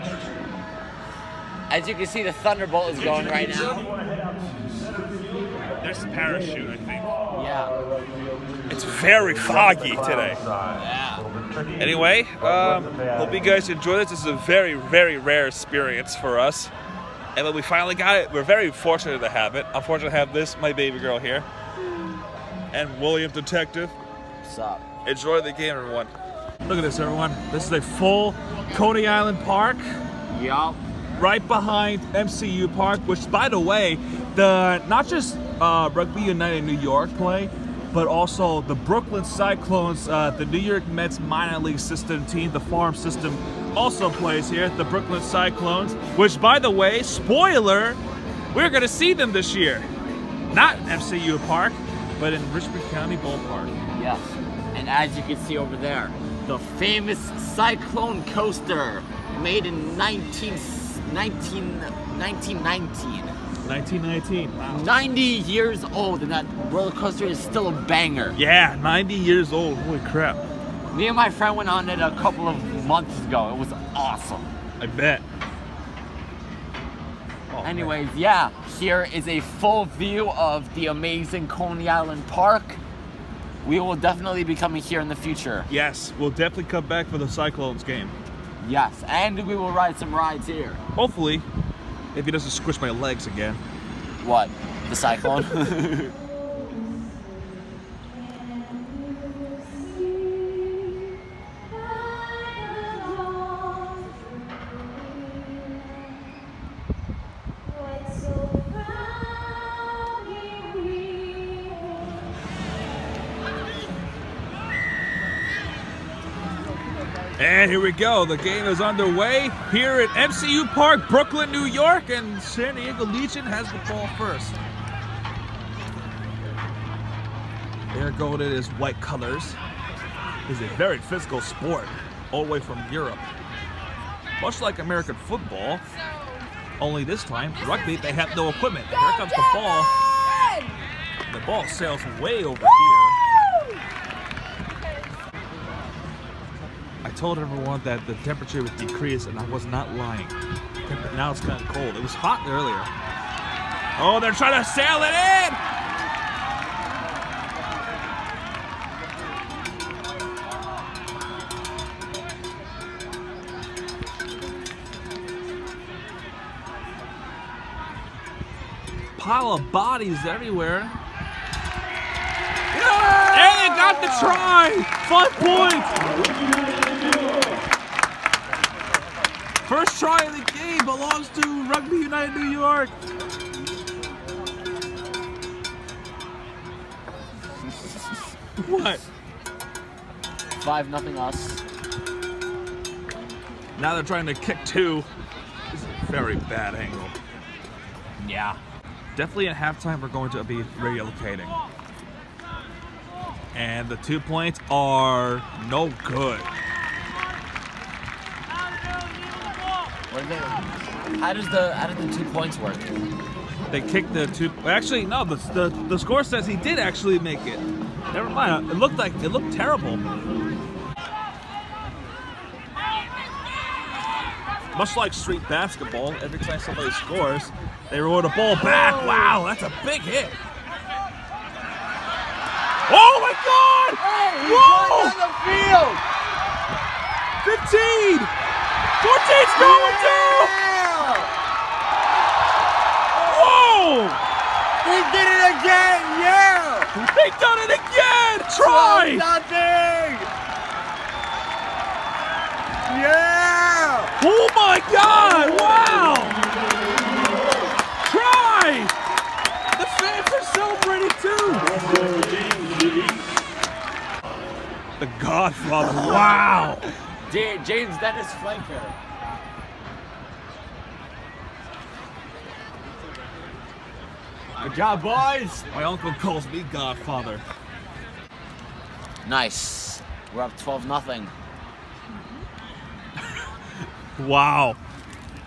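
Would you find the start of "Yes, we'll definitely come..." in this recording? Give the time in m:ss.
1:25.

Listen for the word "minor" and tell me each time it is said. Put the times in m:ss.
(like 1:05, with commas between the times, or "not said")
0:41.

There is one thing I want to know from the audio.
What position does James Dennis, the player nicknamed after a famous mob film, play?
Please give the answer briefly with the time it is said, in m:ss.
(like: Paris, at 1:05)
flanker, at 4:28.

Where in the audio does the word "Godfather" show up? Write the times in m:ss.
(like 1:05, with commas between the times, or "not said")
4:25, 4:36.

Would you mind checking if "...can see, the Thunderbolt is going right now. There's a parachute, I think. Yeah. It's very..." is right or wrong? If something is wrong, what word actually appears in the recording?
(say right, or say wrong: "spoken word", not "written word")
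right.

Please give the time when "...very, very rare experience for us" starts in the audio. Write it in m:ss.
0:14.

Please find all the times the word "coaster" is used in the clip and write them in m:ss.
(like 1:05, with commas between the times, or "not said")
0:58, 1:06.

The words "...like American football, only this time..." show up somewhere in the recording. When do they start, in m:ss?
2:14.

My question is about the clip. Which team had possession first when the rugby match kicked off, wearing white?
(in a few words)
San Diego Legion.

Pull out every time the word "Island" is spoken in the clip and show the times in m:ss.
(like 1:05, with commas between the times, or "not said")
0:29, 1:21.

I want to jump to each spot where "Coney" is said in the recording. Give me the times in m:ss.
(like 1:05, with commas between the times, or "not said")
0:28, 1:21.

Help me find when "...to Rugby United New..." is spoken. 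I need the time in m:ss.
3:01.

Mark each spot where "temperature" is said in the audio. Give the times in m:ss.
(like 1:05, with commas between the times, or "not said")
2:28.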